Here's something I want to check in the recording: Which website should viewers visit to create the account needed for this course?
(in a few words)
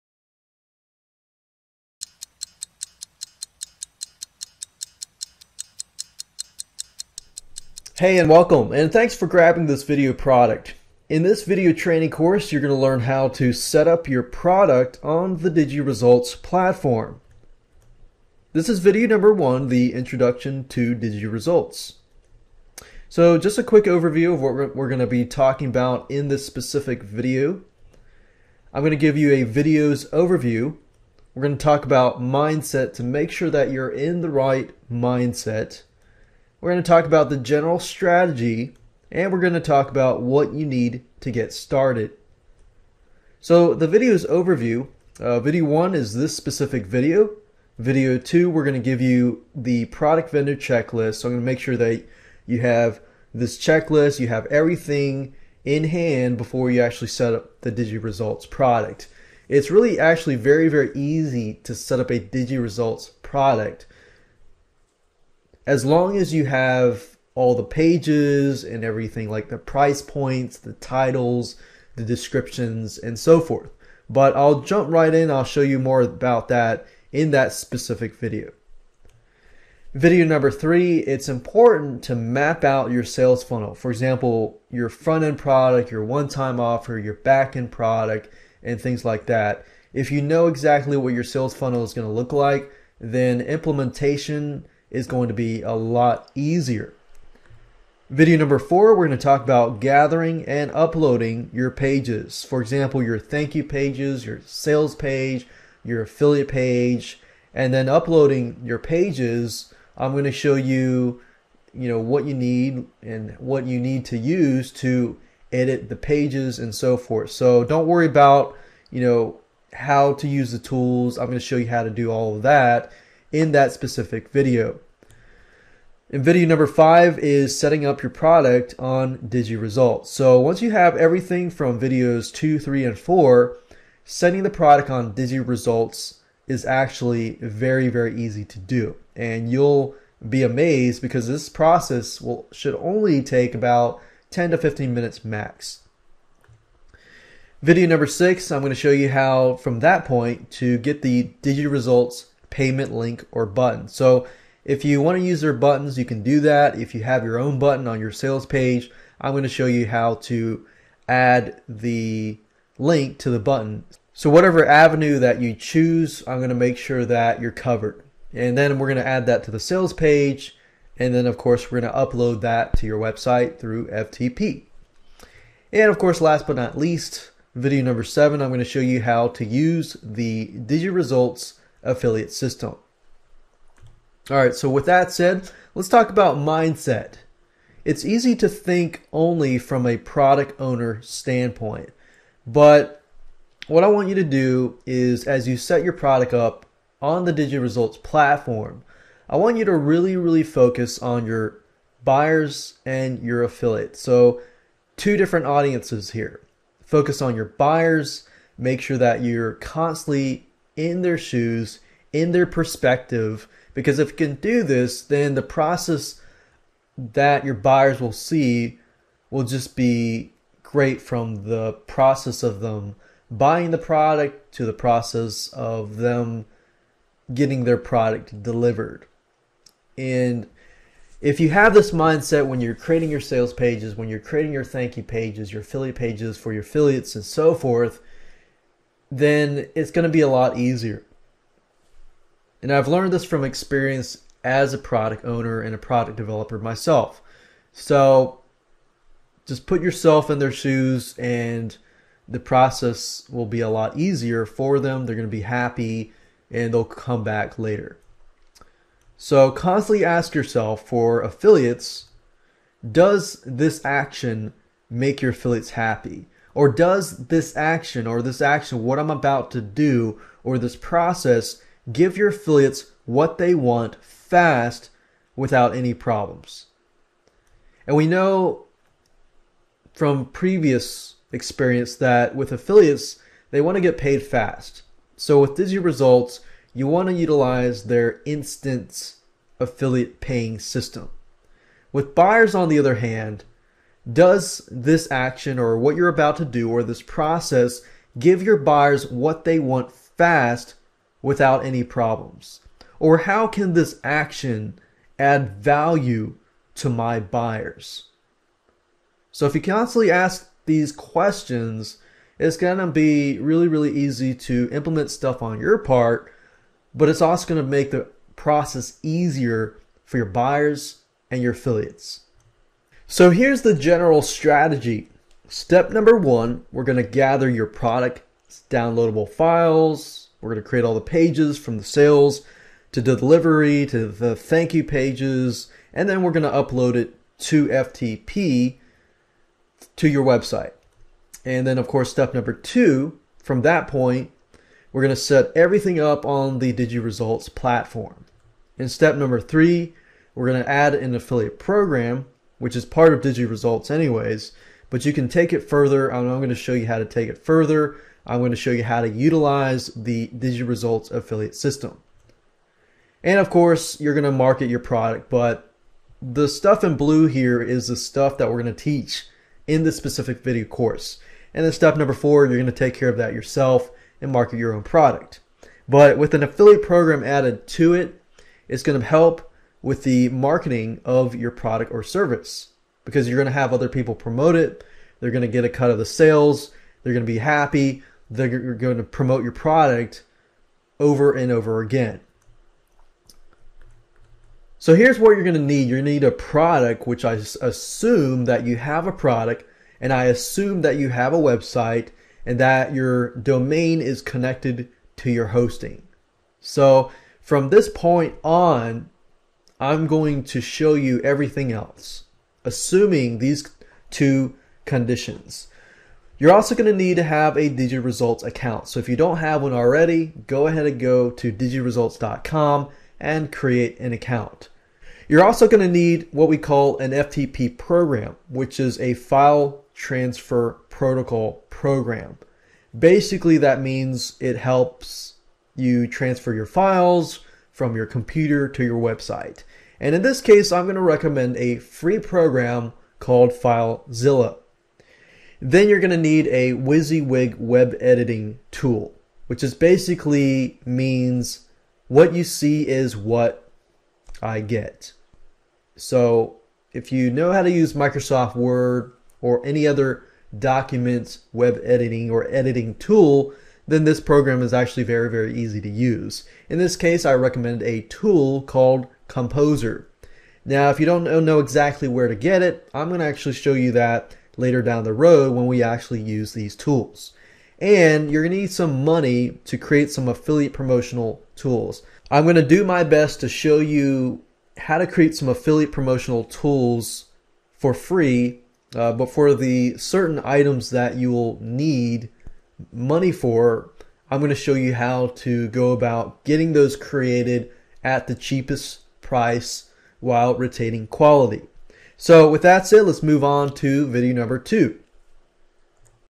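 digiresults.com.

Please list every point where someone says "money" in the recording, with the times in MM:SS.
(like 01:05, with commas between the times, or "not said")
07:59, 08:12.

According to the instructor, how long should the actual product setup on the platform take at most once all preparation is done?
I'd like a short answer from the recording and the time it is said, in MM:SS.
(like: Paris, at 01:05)
10 to 15 minutes, at 02:24.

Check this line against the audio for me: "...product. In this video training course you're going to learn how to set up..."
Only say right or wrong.
right.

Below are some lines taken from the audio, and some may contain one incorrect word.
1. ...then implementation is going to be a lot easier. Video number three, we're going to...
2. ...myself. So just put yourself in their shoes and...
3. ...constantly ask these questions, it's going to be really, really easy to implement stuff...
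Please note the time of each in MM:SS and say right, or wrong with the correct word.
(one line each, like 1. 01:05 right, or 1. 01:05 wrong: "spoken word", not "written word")
1. 01:33 wrong: "four", not "three"
2. 04:06 right
3. 05:09 right.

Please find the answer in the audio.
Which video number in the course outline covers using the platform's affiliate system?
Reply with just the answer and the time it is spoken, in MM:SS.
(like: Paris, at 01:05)
7, at 02:58.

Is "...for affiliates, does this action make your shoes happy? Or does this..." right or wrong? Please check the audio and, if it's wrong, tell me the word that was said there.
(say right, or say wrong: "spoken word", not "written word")
wrong: "affiliates", not "shoes".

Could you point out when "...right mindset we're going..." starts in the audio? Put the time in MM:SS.
00:34.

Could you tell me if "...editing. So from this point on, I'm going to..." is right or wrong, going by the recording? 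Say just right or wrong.
wrong.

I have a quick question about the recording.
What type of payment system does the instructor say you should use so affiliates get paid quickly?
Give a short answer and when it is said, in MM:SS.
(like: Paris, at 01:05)
instant affiliate paying system, at 04:48.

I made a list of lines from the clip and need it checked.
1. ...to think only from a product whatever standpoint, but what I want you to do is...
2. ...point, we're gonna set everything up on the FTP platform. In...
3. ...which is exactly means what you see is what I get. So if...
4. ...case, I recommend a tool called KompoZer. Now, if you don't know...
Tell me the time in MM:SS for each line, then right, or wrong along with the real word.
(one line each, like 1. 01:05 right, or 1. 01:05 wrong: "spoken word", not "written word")
1. 03:08 wrong: "owner", not "whatever"
2. 05:43 wrong: "DigiResults", not "FTP"
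3. 07:29 wrong: "basically", not "exactly"
4. 07:46 right.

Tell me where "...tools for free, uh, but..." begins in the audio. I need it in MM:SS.
08:06.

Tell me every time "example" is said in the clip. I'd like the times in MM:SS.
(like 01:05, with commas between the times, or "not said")
01:23, 01:42.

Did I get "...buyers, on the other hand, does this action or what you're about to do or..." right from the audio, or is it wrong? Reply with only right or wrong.
right.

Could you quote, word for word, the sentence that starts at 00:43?
So the video's overview, uh, video one is this specific video.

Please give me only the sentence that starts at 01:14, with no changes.
But I'll jump right in, I'll show you more about that in that specific video.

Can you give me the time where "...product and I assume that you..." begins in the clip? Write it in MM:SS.
06:39.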